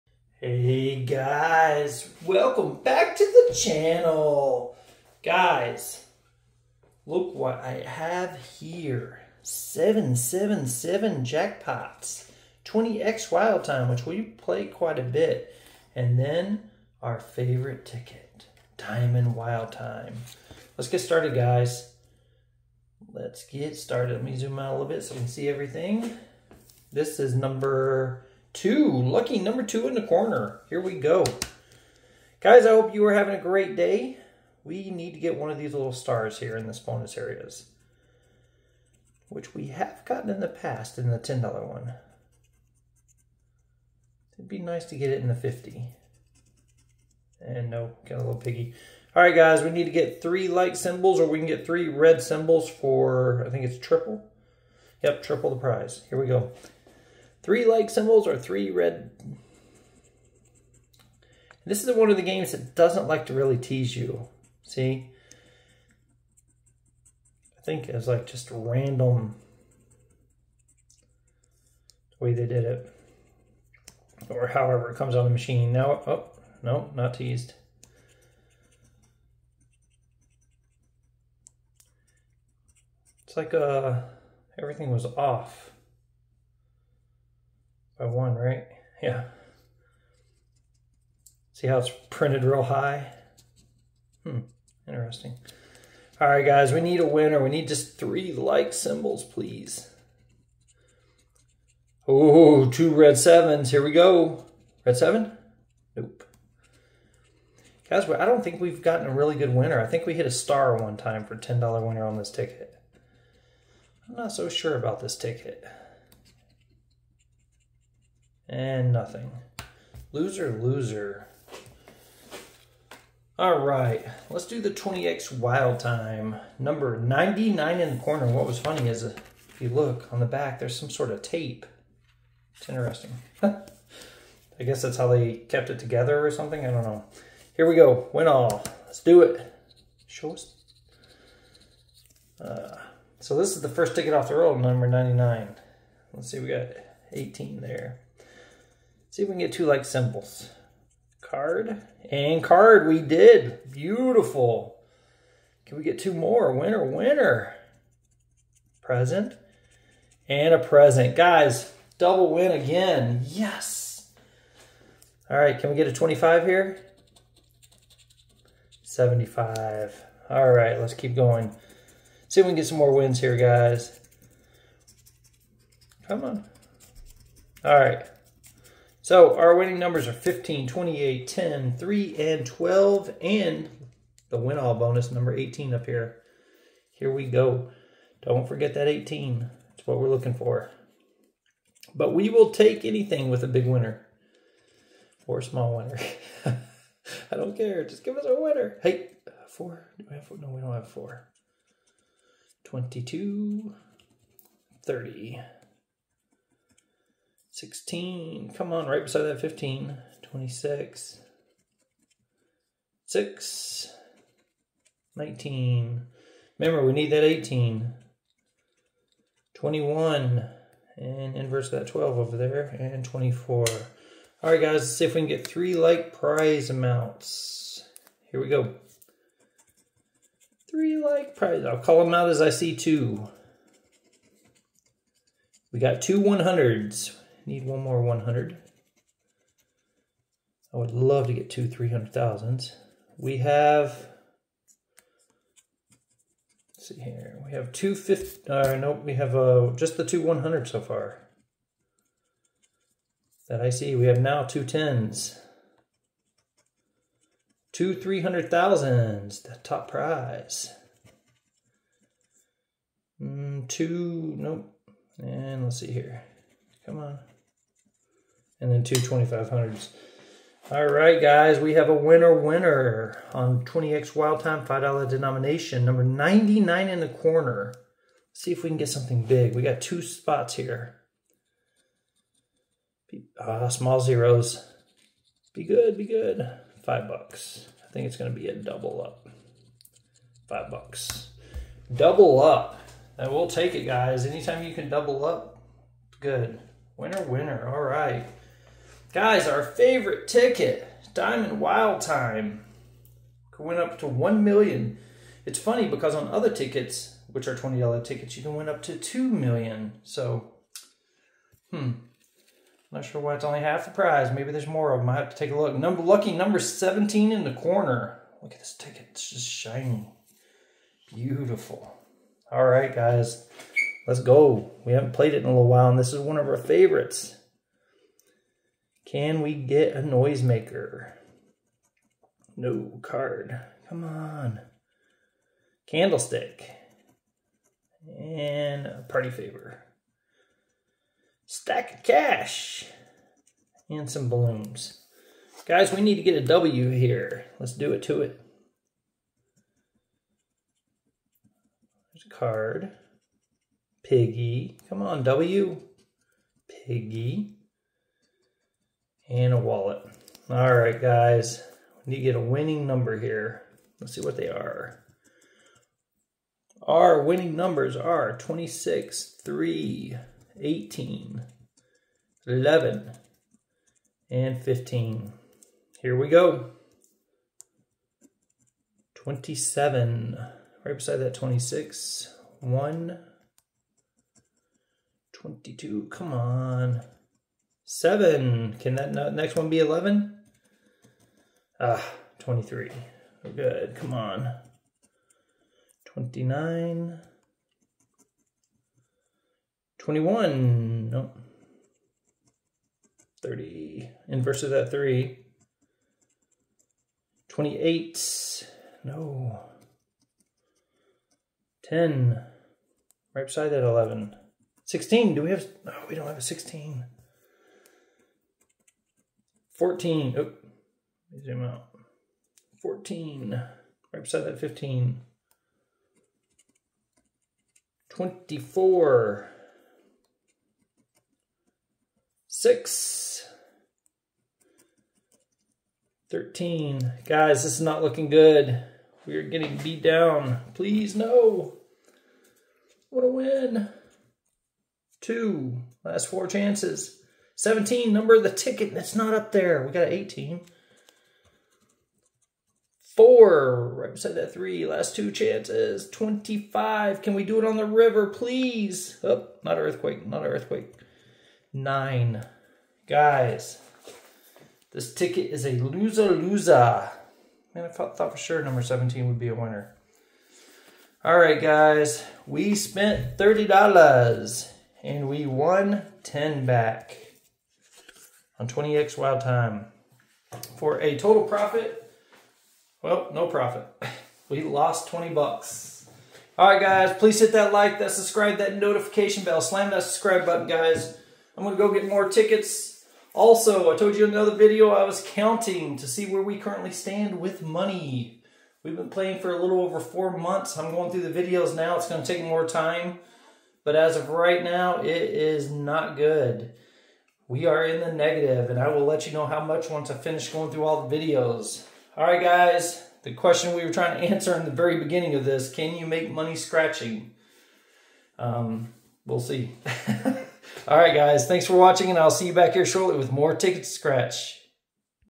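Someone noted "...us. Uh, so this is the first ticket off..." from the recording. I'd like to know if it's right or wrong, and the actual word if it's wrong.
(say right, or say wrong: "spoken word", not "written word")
right.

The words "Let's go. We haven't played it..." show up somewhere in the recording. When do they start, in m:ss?
5:24.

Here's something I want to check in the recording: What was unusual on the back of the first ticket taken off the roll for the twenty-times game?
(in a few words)
Tape.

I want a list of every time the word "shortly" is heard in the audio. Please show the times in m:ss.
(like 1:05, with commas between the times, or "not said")
8:42.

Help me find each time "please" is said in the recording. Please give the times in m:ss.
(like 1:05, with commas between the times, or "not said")
1:39, 7:20, 7:38, 8:07.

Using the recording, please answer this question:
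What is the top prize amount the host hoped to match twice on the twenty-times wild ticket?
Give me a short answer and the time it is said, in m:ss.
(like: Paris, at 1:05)
300,000, at 4:17.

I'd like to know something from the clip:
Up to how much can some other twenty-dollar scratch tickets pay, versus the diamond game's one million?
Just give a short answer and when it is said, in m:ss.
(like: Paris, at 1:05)
2 million, at 5:08.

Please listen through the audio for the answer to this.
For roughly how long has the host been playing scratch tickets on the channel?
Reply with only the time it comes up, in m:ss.
8:19.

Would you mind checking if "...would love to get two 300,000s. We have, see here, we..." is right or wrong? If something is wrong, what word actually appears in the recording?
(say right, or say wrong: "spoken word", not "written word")
right.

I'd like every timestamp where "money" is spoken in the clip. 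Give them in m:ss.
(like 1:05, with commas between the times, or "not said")
8:17, 8:36.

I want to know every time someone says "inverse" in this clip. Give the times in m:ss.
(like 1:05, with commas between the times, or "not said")
3:41, 6:44.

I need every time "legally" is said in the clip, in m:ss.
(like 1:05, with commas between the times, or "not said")
not said.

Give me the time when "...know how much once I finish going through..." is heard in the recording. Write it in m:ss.
8:29.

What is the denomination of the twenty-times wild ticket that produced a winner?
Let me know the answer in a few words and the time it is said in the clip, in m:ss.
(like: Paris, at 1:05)
$5, at 4:34.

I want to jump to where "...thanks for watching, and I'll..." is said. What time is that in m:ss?
8:41.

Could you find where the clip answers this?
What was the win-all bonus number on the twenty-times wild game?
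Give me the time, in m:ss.
3:04.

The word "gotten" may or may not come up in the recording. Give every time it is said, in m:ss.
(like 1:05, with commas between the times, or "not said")
0:40, 1:48.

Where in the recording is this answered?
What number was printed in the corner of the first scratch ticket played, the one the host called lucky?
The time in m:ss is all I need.
0:28.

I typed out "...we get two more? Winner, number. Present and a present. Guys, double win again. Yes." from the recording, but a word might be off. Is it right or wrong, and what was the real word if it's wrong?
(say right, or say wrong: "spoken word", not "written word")
wrong: "winner", not "number".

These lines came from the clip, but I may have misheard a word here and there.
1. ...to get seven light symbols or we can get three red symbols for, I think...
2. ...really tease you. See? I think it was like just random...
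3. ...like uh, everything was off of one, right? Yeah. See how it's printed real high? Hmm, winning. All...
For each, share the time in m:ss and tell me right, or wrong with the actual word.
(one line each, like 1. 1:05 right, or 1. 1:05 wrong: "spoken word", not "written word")
1. 0:49 wrong: "three", not "seven"
2. 1:03 right
3. 1:23 wrong: "interesting", not "winning".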